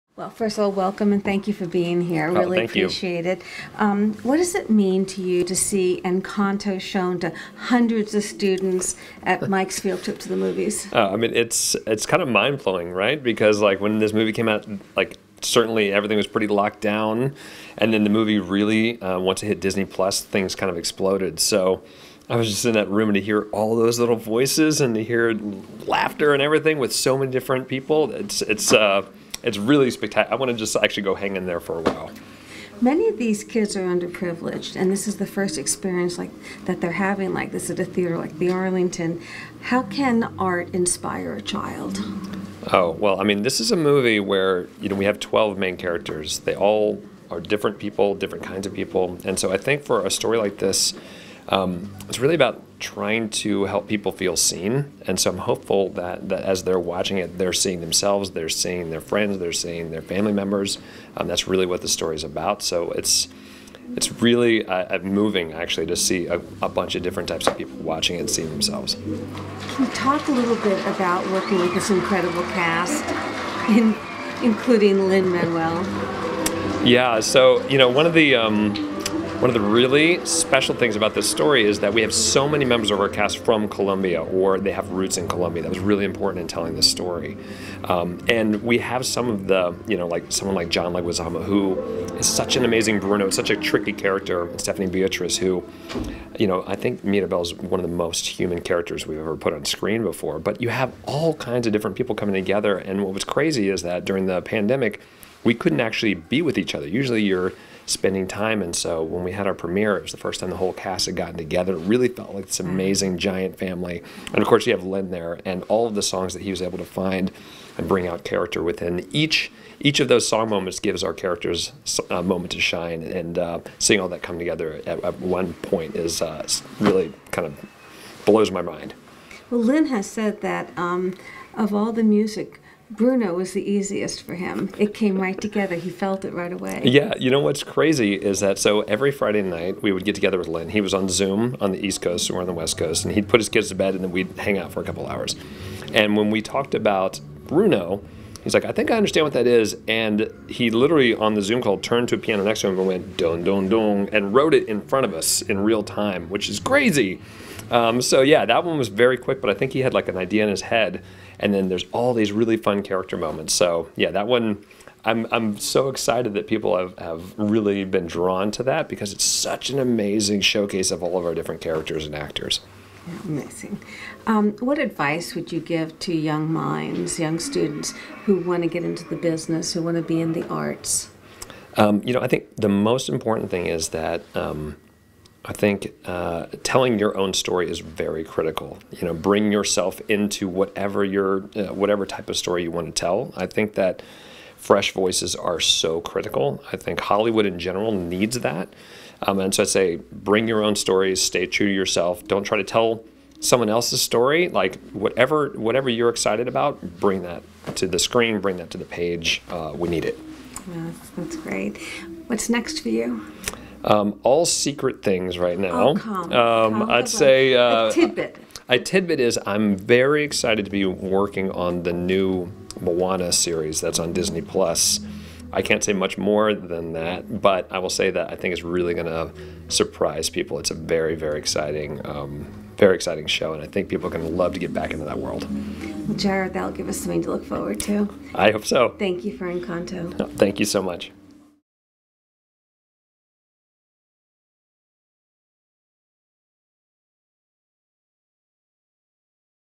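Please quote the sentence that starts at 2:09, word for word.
Well, Lin has said that um, of all the music Bruno was the easiest for him.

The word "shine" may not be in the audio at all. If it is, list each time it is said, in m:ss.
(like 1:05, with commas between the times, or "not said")
2:02.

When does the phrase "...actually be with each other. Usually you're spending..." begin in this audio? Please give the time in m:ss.
1:45.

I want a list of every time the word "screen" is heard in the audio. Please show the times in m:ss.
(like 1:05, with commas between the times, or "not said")
1:39, 3:27.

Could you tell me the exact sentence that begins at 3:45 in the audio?
I can't say much more than that, but I will say that I think it's really going to surprise people.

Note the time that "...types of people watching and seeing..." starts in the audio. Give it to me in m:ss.
1:07.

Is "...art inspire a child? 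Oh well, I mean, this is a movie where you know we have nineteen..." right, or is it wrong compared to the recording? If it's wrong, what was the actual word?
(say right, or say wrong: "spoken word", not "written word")
wrong: "twelve", not "nineteen".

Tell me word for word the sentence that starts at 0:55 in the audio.
And so I'm hopeful that, that as they're watching it, they're seeing themselves, they're seeing their friends, they're seeing their family members.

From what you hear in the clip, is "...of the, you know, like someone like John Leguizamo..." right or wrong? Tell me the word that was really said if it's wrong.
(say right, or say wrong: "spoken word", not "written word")
right.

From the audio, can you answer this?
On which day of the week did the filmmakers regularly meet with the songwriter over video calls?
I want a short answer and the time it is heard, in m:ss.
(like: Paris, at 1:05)
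Friday, at 2:19.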